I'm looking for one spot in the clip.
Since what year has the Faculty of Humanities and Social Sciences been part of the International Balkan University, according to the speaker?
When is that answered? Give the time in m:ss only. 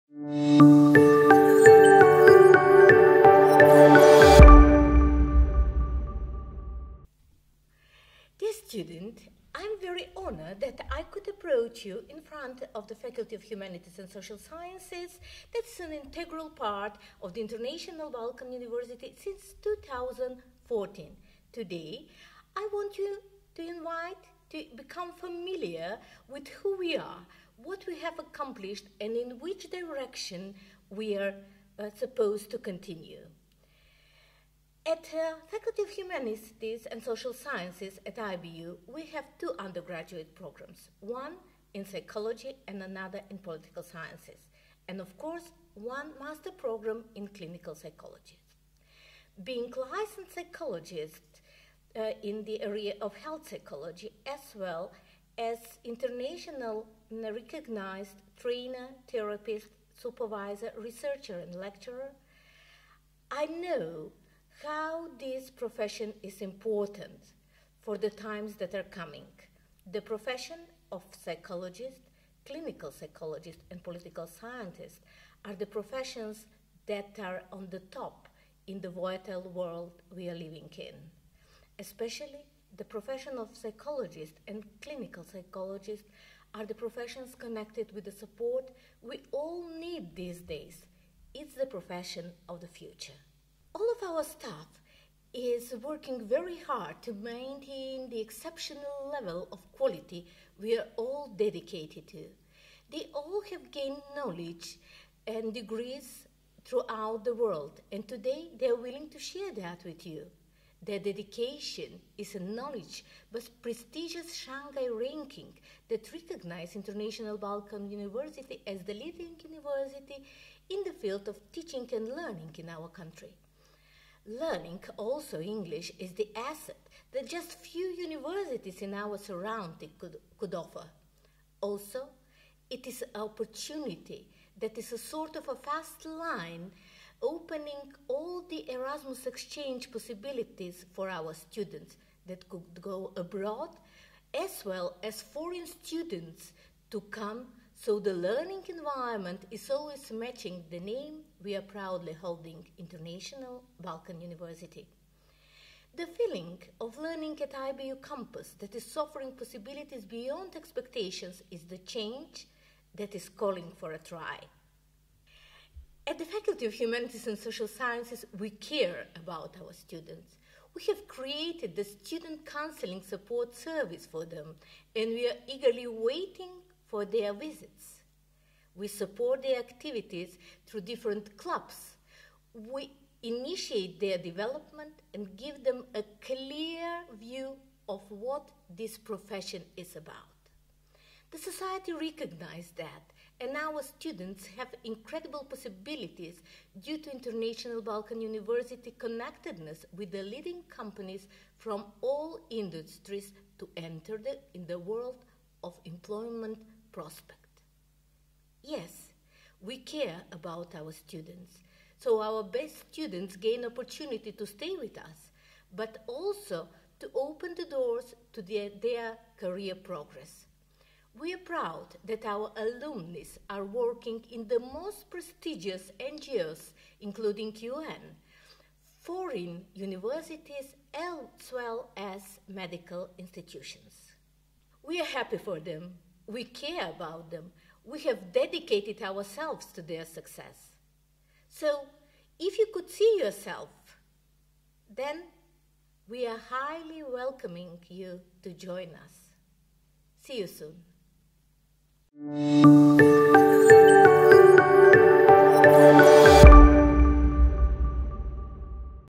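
0:19.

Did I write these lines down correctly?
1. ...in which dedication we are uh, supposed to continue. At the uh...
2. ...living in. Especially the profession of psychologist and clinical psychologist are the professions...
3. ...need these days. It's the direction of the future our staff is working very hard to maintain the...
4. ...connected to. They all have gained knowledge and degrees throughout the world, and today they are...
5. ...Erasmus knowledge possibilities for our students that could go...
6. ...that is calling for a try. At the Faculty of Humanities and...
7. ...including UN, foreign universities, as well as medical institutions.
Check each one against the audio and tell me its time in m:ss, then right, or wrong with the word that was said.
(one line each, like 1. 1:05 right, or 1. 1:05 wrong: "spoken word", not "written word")
1. 0:29 wrong: "direction", not "dedication"
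2. 1:20 right
3. 1:29 wrong: "profession", not "direction"
4. 1:41 wrong: "dedicated", not "connected"
5. 2:18 wrong: "exchange", not "knowledge"
6. 2:42 right
7. 3:47 right.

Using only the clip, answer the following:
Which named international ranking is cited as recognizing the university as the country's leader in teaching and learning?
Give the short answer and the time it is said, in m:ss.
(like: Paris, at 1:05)
Shanghai ranking, at 1:54.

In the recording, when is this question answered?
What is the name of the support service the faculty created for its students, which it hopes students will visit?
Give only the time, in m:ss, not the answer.
2:51.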